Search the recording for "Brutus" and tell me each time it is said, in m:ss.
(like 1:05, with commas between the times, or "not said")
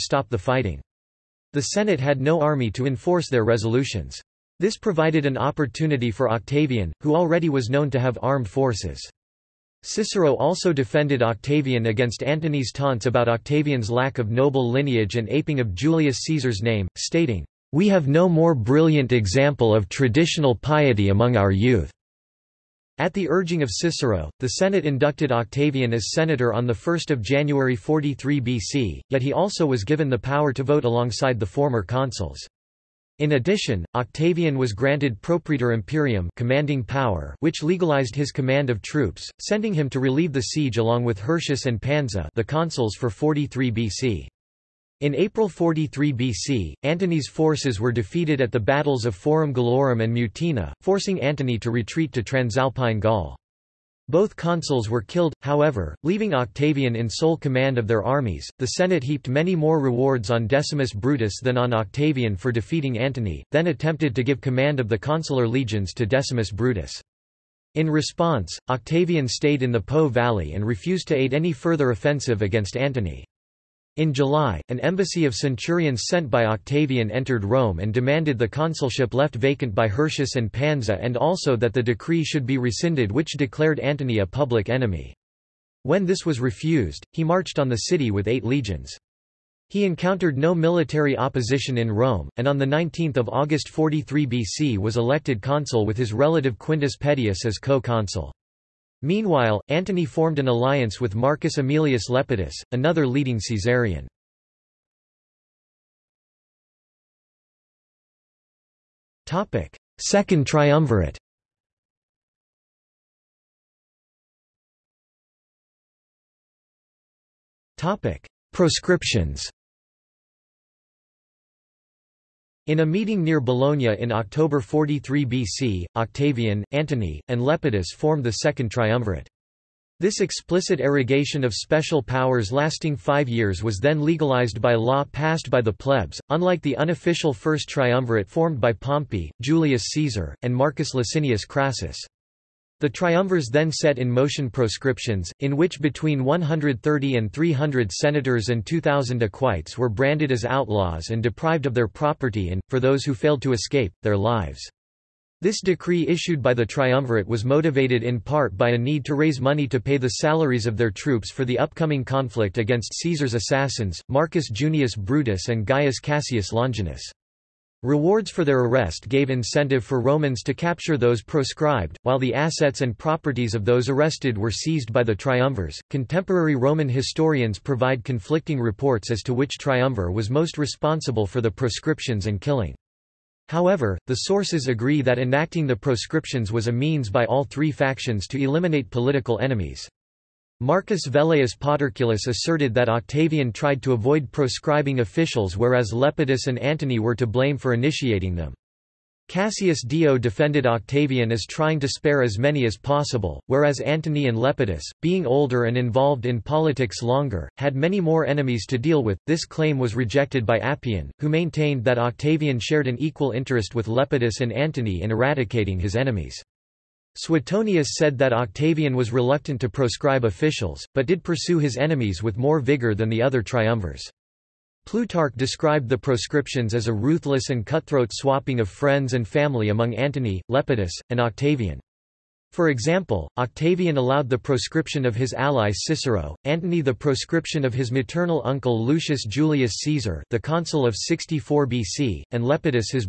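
1:00, 1:06, 2:44.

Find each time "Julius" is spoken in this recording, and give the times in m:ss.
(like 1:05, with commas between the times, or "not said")
0:15, 2:19, 3:59.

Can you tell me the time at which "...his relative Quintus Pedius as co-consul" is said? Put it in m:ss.
1:35.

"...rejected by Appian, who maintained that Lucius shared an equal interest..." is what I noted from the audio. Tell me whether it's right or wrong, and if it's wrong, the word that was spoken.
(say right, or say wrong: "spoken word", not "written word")
wrong: "Octavian", not "Lucius".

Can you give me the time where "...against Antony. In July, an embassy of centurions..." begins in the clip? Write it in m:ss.
1:12.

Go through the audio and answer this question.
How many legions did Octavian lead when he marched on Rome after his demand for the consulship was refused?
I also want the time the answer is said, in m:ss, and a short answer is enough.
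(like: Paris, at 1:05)
8, at 1:28.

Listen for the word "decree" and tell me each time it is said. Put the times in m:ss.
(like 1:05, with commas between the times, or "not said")
1:21, 2:35.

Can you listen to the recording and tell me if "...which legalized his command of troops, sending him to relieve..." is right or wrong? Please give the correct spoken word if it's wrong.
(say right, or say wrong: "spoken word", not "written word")
right.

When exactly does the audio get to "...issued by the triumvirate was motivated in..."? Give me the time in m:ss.
2:36.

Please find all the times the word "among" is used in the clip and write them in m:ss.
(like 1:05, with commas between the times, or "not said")
0:21, 3:49.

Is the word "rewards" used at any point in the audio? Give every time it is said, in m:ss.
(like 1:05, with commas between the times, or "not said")
0:59, 2:47.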